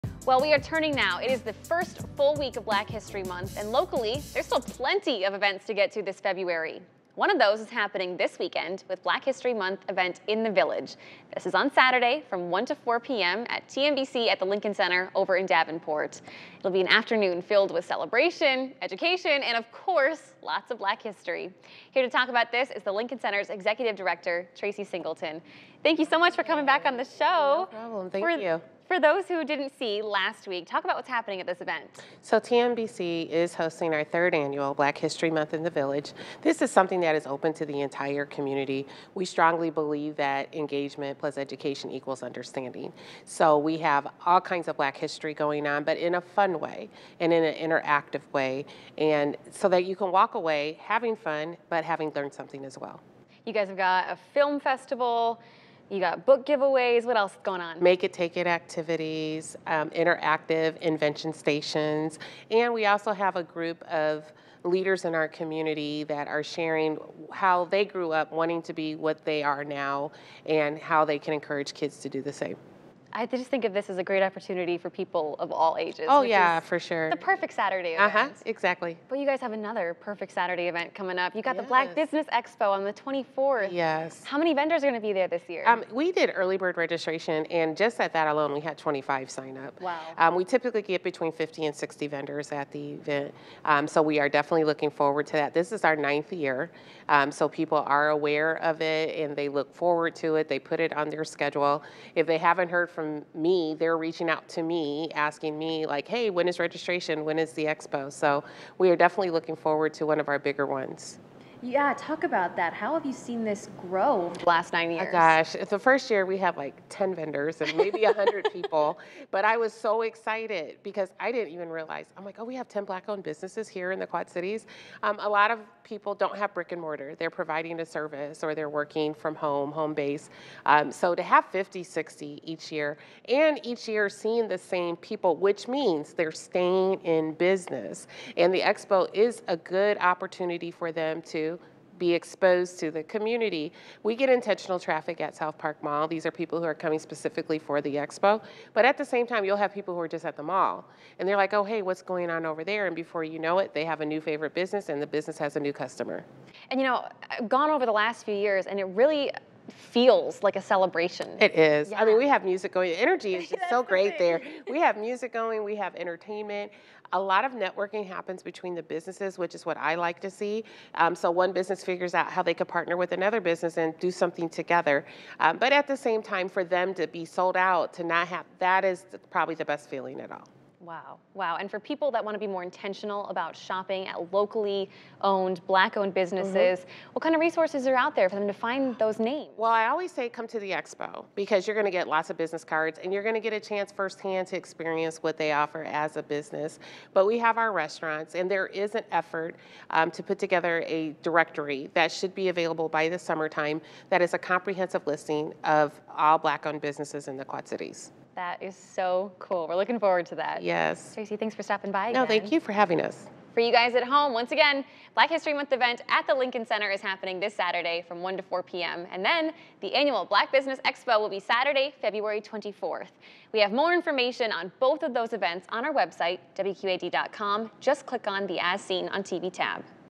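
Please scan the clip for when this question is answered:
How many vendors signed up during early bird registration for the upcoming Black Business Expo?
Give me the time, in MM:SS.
01:28.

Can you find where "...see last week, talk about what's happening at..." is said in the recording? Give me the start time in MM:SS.
00:29.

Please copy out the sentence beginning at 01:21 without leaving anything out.
the Black Business Expo on the 24th.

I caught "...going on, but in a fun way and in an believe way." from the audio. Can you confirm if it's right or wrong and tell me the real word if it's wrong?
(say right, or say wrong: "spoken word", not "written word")
wrong: "interactive", not "believe".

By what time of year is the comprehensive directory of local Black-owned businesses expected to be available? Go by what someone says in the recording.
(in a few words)
summertime.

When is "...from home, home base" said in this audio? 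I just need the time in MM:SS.
02:09.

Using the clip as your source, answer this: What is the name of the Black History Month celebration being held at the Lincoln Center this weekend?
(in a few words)
Black History Month in the Village.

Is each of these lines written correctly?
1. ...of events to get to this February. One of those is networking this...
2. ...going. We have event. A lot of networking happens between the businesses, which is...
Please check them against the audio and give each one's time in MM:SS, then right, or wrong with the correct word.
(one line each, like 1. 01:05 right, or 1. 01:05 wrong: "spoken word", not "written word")
1. 00:05 wrong: "happening", not "networking"
2. 02:45 wrong: "entertainment", not "event".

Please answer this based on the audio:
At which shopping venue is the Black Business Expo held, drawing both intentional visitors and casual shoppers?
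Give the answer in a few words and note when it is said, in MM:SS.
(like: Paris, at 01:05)
South Park Mall, at 02:25.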